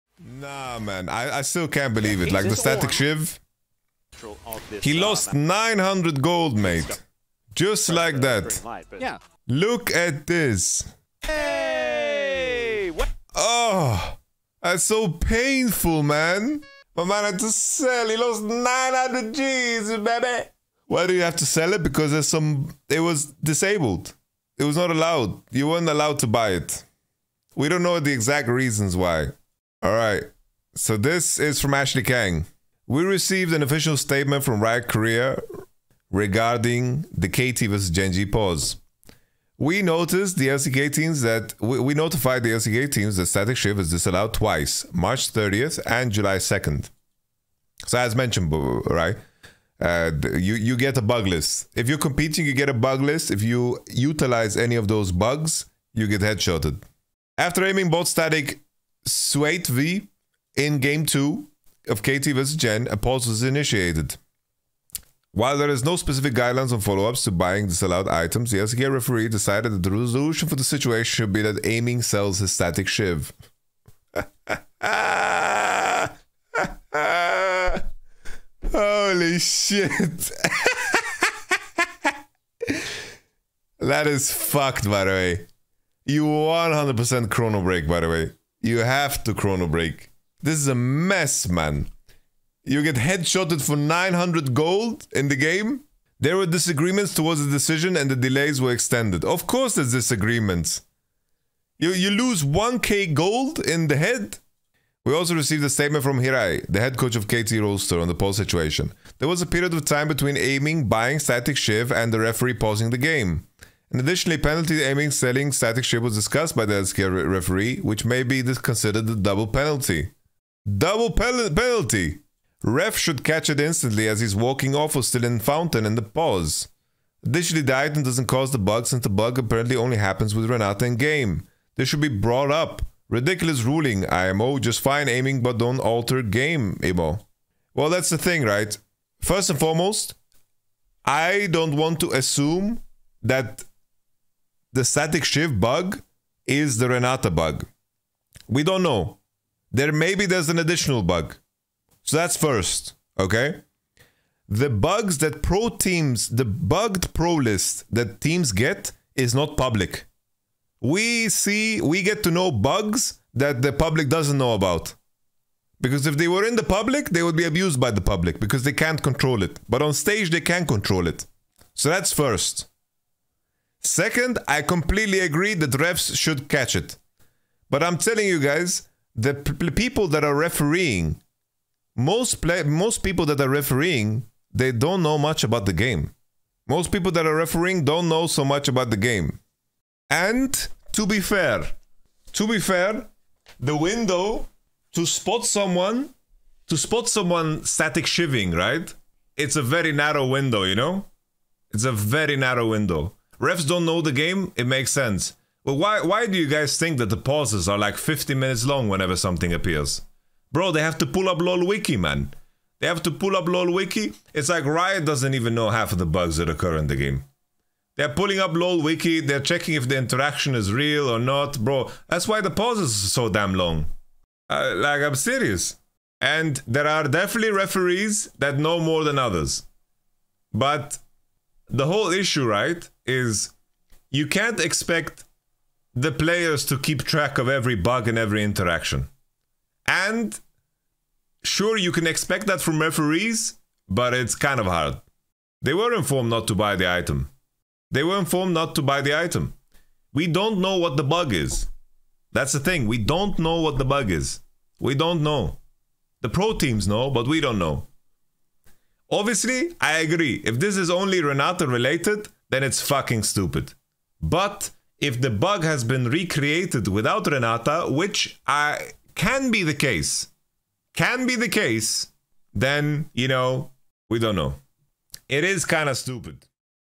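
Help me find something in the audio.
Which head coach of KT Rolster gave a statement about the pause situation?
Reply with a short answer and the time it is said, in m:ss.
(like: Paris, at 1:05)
Hirai, at 1:46.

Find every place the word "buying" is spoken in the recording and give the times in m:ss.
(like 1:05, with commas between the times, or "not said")
1:07, 1:50.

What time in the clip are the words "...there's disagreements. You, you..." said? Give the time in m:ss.
1:39.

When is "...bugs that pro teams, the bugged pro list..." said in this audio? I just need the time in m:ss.
2:34.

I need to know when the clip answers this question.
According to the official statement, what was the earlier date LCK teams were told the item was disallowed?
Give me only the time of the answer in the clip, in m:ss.
0:44.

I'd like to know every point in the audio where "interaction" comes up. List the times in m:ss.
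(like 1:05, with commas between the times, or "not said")
3:39, 3:58.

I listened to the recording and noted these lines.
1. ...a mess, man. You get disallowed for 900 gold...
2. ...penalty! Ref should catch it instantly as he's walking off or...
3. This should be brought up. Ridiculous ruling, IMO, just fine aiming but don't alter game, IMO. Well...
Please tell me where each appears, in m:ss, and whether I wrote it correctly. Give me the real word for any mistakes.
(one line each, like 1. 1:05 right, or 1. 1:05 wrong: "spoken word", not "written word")
1. 1:30 wrong: "headshotted", not "disallowed"
2. 2:01 right
3. 2:11 right.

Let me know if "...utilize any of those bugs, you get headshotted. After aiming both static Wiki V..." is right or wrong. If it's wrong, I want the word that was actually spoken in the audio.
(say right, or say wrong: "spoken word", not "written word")
wrong: "Swate", not "Wiki".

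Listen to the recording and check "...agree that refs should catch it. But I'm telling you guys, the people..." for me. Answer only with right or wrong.
right.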